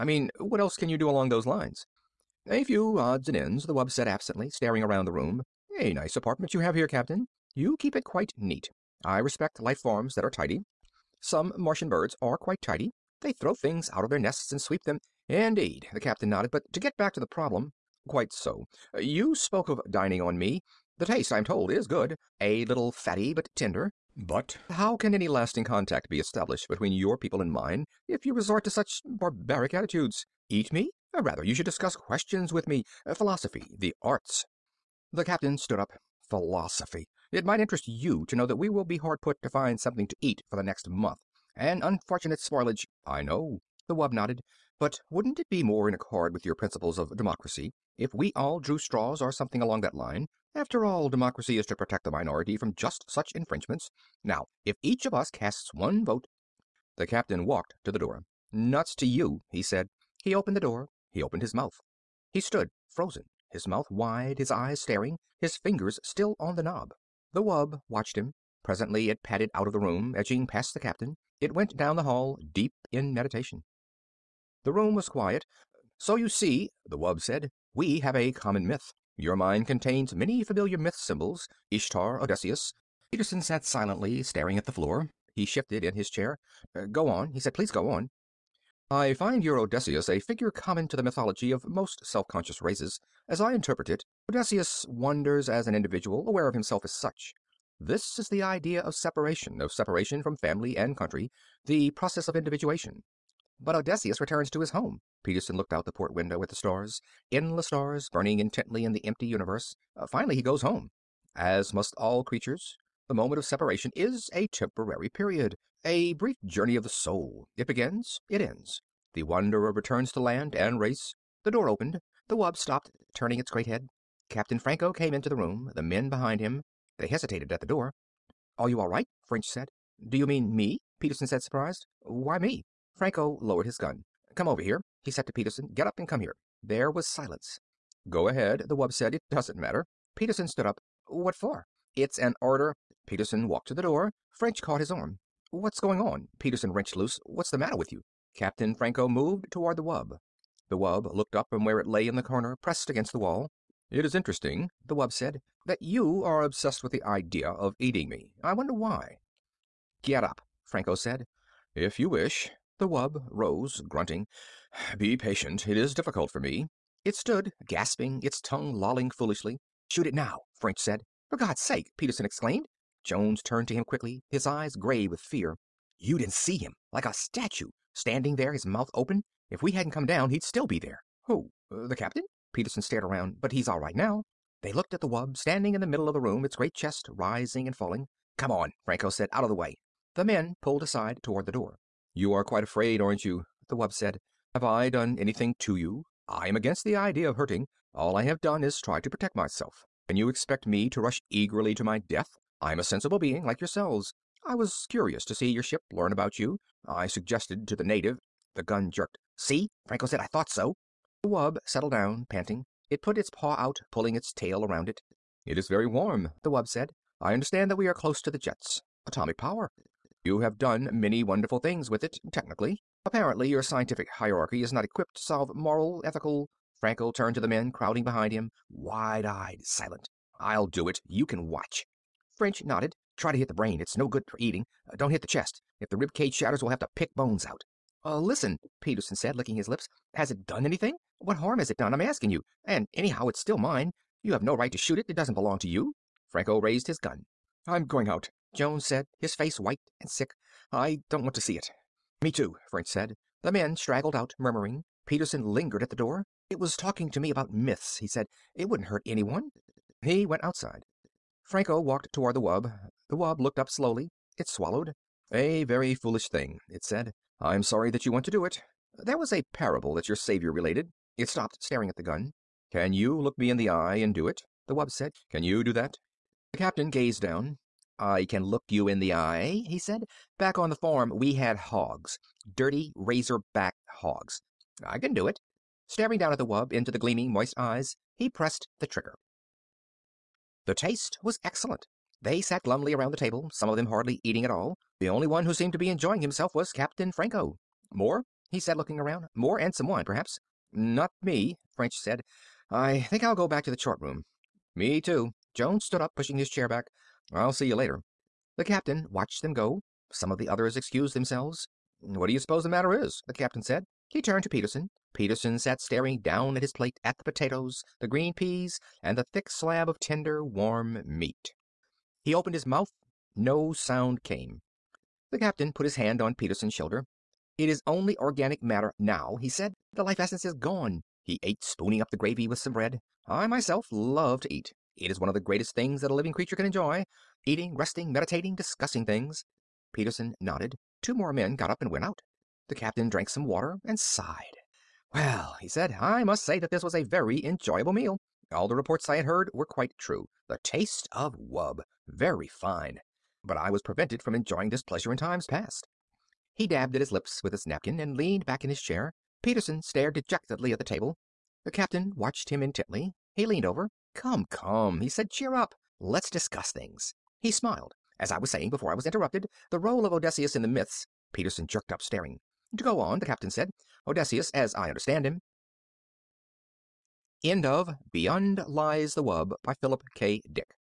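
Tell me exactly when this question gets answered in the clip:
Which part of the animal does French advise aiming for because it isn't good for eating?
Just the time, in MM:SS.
03:53.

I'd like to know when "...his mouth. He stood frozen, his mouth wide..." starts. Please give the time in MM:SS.
01:01.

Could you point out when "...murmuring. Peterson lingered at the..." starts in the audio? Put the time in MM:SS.
04:14.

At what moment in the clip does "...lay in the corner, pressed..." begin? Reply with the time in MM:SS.
02:31.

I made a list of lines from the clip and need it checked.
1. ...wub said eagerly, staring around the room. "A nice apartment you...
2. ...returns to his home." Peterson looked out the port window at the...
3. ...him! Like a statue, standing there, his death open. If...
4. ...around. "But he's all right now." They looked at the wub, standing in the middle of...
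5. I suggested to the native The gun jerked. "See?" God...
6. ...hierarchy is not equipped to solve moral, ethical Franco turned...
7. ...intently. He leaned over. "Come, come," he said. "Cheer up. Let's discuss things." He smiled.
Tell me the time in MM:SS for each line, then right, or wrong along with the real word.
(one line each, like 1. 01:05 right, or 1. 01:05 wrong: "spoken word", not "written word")
1. 00:03 wrong: "absently", not "eagerly"
2. 01:44 right
3. 02:56 wrong: "mouth", not "death"
4. 03:03 right
5. 03:26 wrong: "Franco", not "God"
6. 03:44 right
7. 06:02 right.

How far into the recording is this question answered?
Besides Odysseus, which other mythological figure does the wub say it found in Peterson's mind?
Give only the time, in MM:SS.
01:21.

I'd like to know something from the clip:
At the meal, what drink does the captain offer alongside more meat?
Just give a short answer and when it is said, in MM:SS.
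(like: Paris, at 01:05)
wine, at 04:59.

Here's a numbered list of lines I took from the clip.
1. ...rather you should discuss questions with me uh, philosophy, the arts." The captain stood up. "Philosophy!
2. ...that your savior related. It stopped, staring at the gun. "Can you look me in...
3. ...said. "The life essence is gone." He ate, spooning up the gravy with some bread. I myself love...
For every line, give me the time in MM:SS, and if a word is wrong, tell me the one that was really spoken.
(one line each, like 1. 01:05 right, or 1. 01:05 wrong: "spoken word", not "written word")
1. 00:31 right
2. 04:29 right
3. 05:29 right.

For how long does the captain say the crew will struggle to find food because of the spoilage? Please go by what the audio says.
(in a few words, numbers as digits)
the next month.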